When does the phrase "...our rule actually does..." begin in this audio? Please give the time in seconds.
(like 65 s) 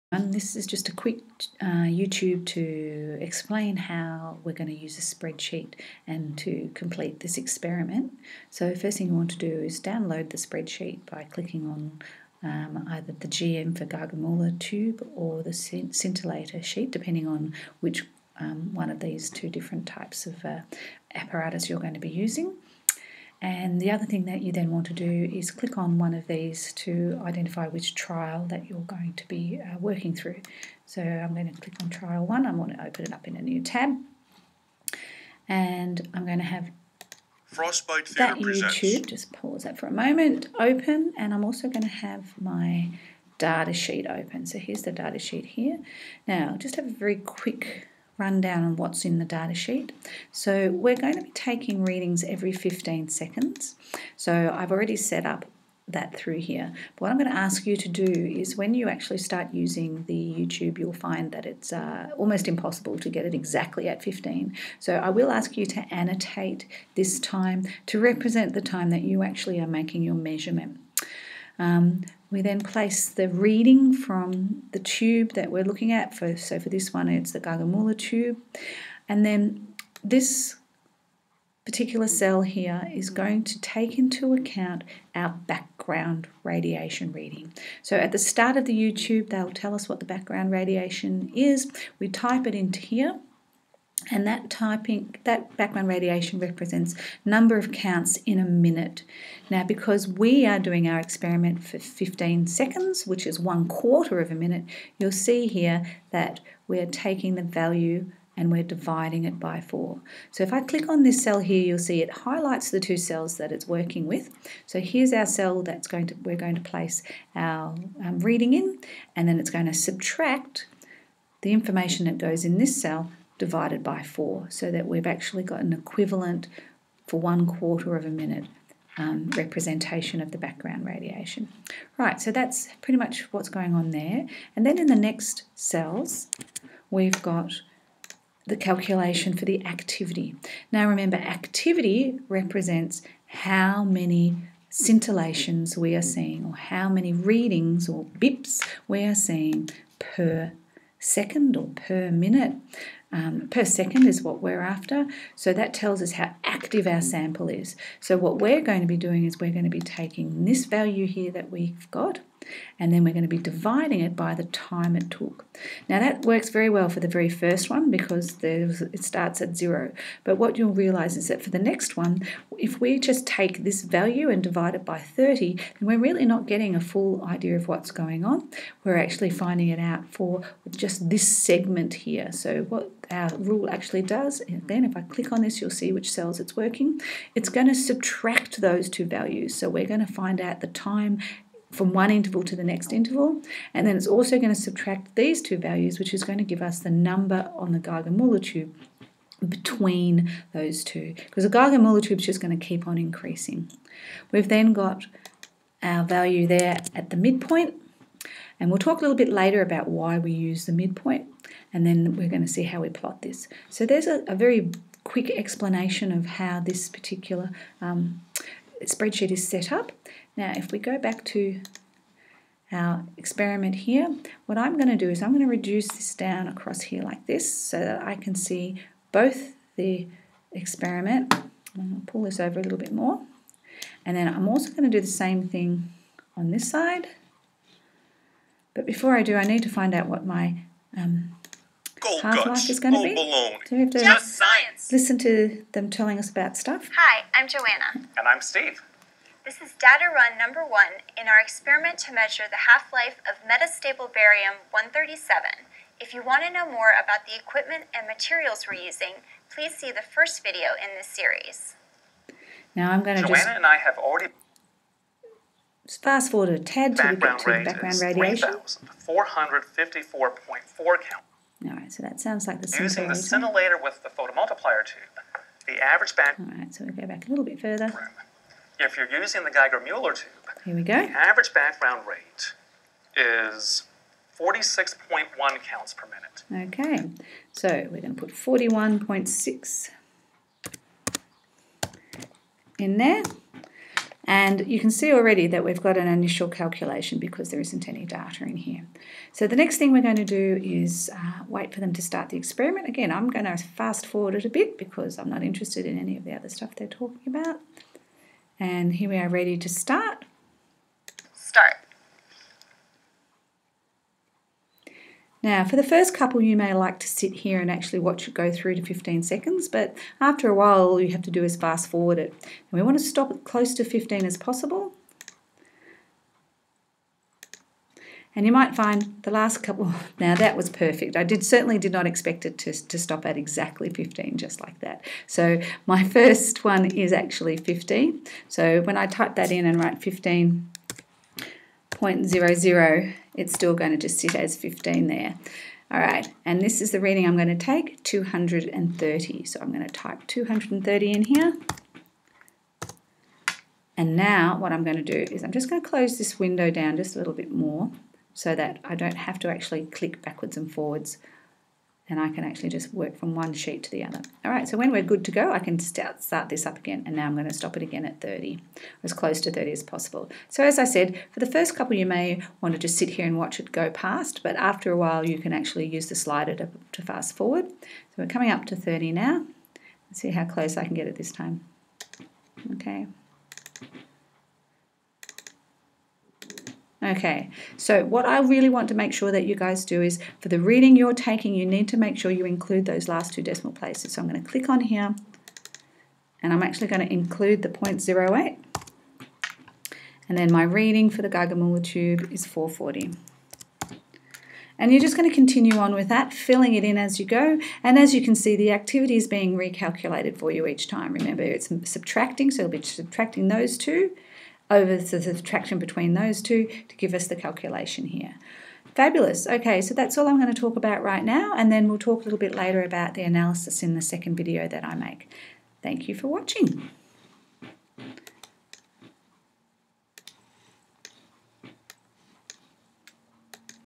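183 s.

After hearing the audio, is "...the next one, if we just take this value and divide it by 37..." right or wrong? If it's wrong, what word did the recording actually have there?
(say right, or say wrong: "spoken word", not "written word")
wrong: "30", not "37".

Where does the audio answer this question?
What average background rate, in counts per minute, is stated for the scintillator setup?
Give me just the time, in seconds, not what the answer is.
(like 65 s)
269 s.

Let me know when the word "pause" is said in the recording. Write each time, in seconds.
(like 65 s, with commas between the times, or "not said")
39 s.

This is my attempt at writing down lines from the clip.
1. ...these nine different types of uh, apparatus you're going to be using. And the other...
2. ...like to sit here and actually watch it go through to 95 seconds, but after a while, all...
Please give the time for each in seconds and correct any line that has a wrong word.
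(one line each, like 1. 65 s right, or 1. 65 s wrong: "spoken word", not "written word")
1. 18 s wrong: "two", not "nine"
2. 316 s wrong: "15", not "95".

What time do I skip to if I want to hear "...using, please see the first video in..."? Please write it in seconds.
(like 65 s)
258 s.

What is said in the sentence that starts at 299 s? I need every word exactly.
So the next thing we're going to do is uh, wait for them to start the experiment.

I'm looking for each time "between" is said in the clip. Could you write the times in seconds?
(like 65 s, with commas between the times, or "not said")
199 s, 415 s.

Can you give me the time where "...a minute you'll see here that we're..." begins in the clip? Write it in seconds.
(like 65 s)
104 s.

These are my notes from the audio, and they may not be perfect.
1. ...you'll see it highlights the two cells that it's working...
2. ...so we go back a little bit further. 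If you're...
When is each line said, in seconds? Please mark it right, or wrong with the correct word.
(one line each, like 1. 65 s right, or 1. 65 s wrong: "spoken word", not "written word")
1. 111 s right
2. 276 s right.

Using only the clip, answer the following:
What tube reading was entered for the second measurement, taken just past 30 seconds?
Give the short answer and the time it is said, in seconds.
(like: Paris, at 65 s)
440, at 402 s.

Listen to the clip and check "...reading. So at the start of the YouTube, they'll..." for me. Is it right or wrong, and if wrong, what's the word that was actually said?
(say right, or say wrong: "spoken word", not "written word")
right.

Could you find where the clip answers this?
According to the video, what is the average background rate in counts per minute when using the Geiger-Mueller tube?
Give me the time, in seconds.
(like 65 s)
284 s.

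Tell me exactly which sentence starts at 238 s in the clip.
But before I do, I need to find out what my um, Gold half life is going to be.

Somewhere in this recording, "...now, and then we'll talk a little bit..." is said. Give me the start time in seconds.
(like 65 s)
421 s.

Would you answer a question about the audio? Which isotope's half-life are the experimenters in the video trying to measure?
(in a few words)
metastable barium 137.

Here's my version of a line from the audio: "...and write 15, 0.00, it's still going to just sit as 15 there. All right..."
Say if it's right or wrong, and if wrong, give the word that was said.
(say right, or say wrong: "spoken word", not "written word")
right.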